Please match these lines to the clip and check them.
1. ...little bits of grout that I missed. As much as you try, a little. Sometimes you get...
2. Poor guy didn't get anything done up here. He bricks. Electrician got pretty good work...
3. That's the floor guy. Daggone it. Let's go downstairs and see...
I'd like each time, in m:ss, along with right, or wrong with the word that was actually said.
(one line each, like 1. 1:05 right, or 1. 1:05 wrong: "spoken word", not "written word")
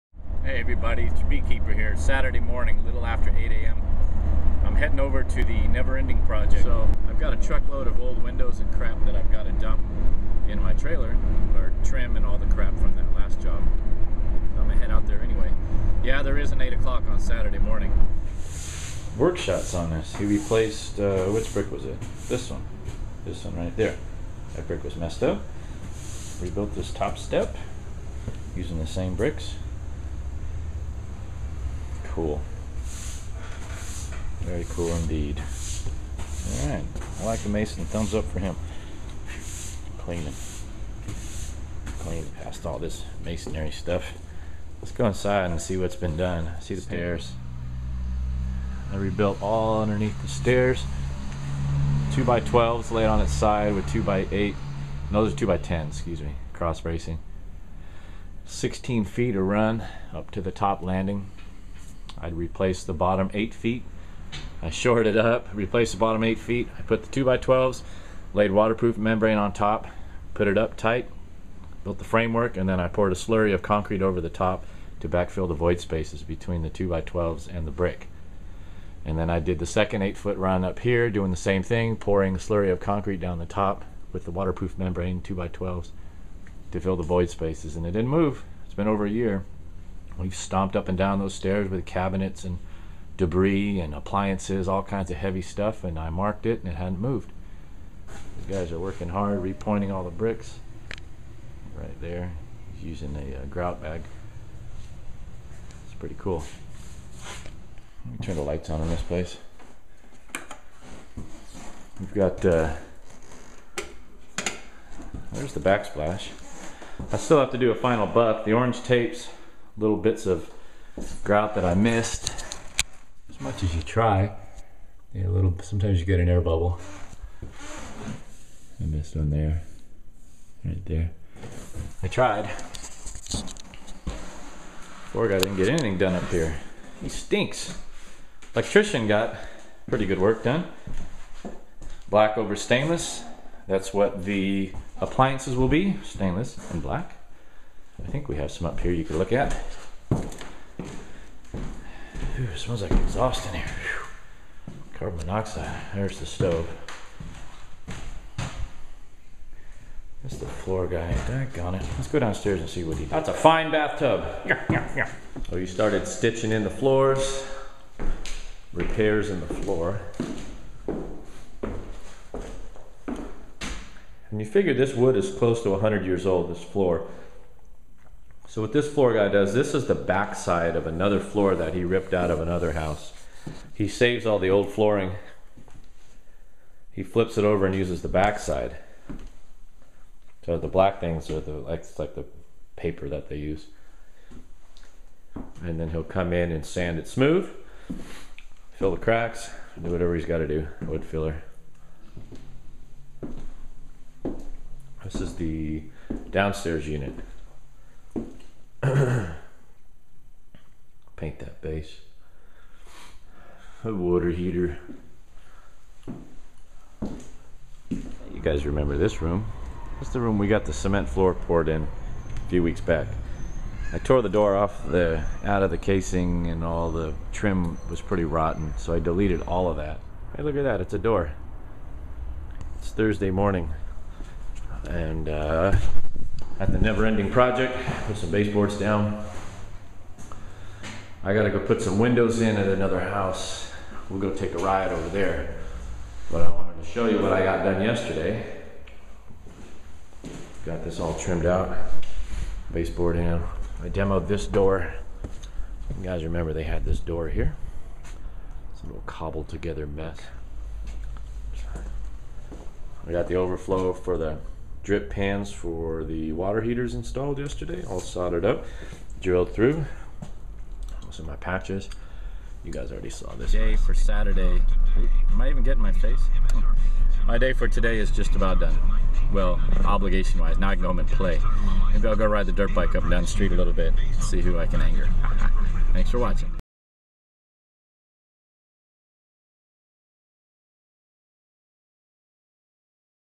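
1. 1:59 right
2. 2:15 wrong: "stinks", not "bricks"
3. 2:40 right.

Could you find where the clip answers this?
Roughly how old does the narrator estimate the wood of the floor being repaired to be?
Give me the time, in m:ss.
2:55.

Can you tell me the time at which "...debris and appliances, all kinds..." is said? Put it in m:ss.
1:33.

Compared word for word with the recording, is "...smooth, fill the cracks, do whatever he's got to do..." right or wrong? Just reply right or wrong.
right.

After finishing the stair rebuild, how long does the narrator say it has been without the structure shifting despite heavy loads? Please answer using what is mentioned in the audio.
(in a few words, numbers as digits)
over a year.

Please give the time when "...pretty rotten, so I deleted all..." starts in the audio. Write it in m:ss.
3:48.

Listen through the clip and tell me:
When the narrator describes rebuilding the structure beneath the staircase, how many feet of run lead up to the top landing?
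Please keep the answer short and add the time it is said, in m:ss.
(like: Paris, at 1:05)
16 feet, at 0:58.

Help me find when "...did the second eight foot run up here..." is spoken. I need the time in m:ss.
1:19.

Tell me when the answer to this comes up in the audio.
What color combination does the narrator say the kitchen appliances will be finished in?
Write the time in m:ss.
2:26.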